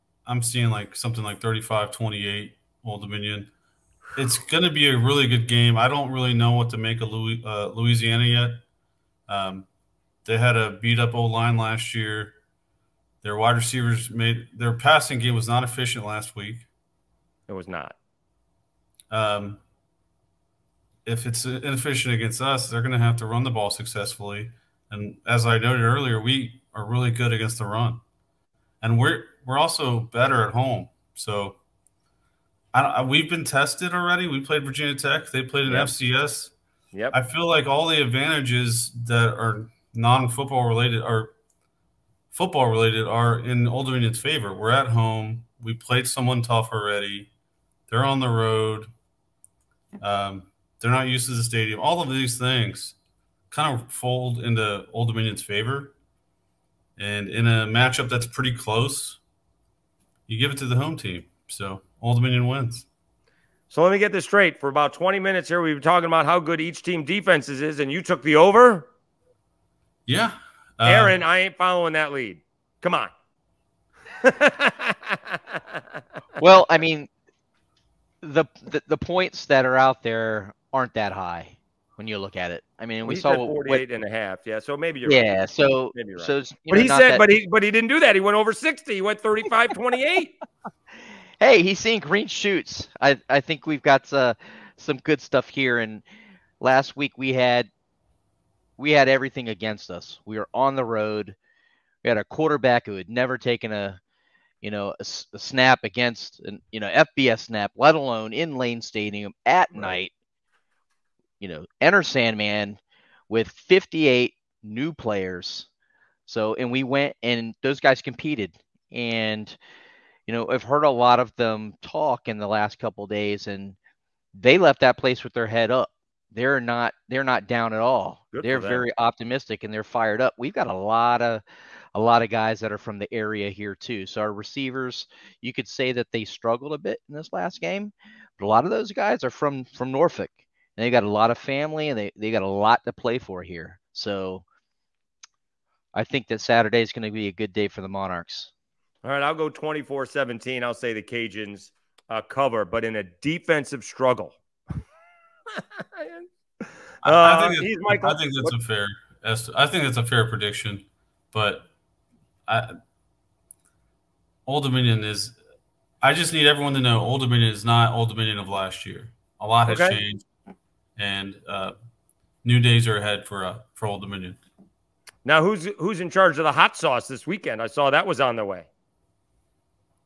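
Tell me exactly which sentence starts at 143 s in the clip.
So I think that Saturday is going to be a good day for the Monarchs.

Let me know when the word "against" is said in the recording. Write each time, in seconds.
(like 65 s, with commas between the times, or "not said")
22 s, 27 s, 99 s, 105 s.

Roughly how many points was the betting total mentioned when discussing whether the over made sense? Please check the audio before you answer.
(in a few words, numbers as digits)
48.5.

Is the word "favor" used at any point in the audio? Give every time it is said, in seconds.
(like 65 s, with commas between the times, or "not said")
44 s, 55 s.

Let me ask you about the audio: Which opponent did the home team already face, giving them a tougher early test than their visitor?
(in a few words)
Virginia Tech.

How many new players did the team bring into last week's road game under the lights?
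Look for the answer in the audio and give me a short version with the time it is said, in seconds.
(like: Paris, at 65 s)
58, at 113 s.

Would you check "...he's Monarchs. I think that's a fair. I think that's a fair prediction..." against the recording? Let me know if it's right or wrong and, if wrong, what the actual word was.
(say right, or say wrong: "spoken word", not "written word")
wrong: "Michael", not "Monarchs".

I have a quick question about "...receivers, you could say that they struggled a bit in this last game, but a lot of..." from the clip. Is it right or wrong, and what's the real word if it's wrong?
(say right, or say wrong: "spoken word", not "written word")
right.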